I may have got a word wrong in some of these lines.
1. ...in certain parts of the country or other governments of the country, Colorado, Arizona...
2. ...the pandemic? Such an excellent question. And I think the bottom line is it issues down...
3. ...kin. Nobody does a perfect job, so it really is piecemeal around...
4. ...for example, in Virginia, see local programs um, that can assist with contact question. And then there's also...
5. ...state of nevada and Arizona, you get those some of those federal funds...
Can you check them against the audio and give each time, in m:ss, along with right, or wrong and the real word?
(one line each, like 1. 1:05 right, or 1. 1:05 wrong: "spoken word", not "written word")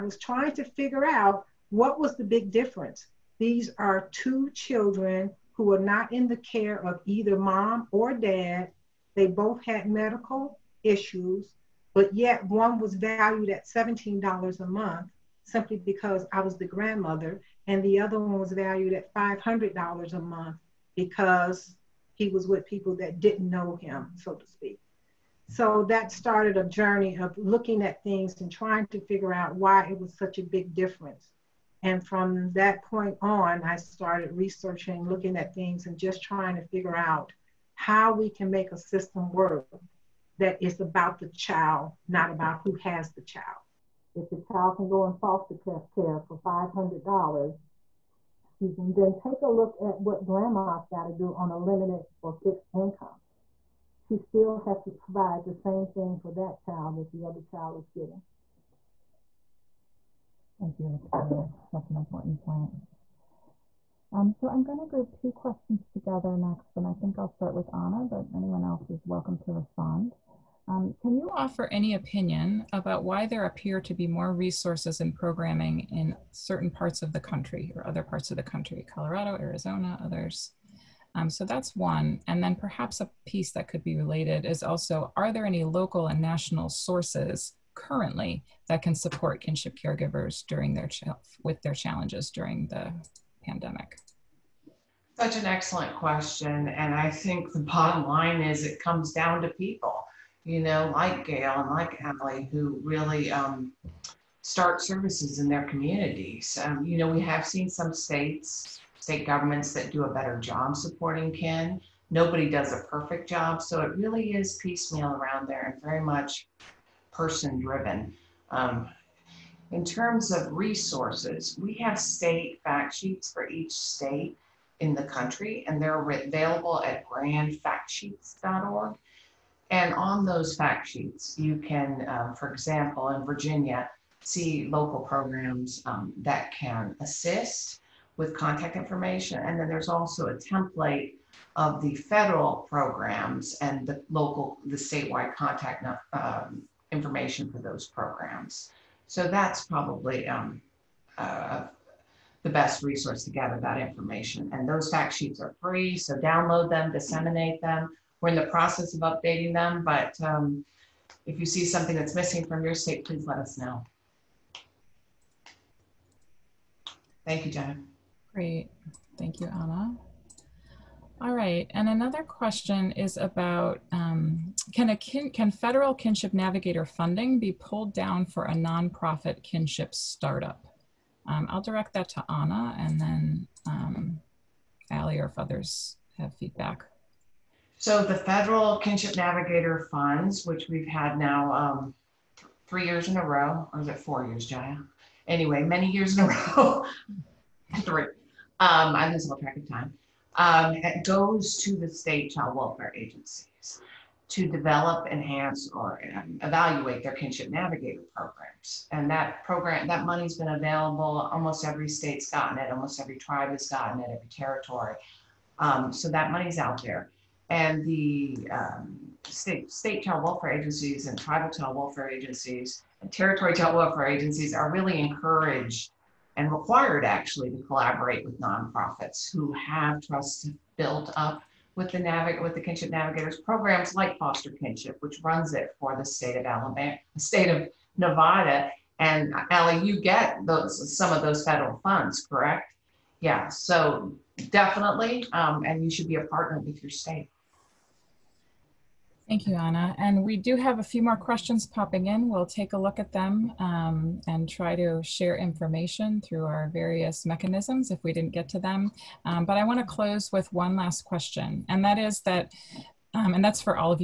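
1. 1:15 wrong: "parts", not "governments"
2. 1:32 wrong: "comes", not "issues"
3. 1:51 right
4. 2:12 wrong: "information", not "question"
5. 3:57 wrong: "Ali", not "Arizona".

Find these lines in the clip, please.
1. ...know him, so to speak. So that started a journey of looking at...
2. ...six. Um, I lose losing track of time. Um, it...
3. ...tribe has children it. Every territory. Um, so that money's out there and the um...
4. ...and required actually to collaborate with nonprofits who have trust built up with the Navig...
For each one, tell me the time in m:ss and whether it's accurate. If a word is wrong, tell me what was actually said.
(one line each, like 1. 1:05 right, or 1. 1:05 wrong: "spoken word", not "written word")
1. 0:23 right
2. 3:17 wrong: "three", not "six"
3. 3:33 wrong: "gotten", not "children"
4. 3:46 right.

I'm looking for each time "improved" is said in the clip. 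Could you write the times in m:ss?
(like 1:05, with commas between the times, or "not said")
not said.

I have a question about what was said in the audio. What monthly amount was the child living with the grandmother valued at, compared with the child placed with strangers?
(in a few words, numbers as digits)
$17.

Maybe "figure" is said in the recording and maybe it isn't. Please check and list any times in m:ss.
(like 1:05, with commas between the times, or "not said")
0:00, 0:29, 0:36.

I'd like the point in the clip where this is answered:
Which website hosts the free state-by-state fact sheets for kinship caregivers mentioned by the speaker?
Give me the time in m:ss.
2:07.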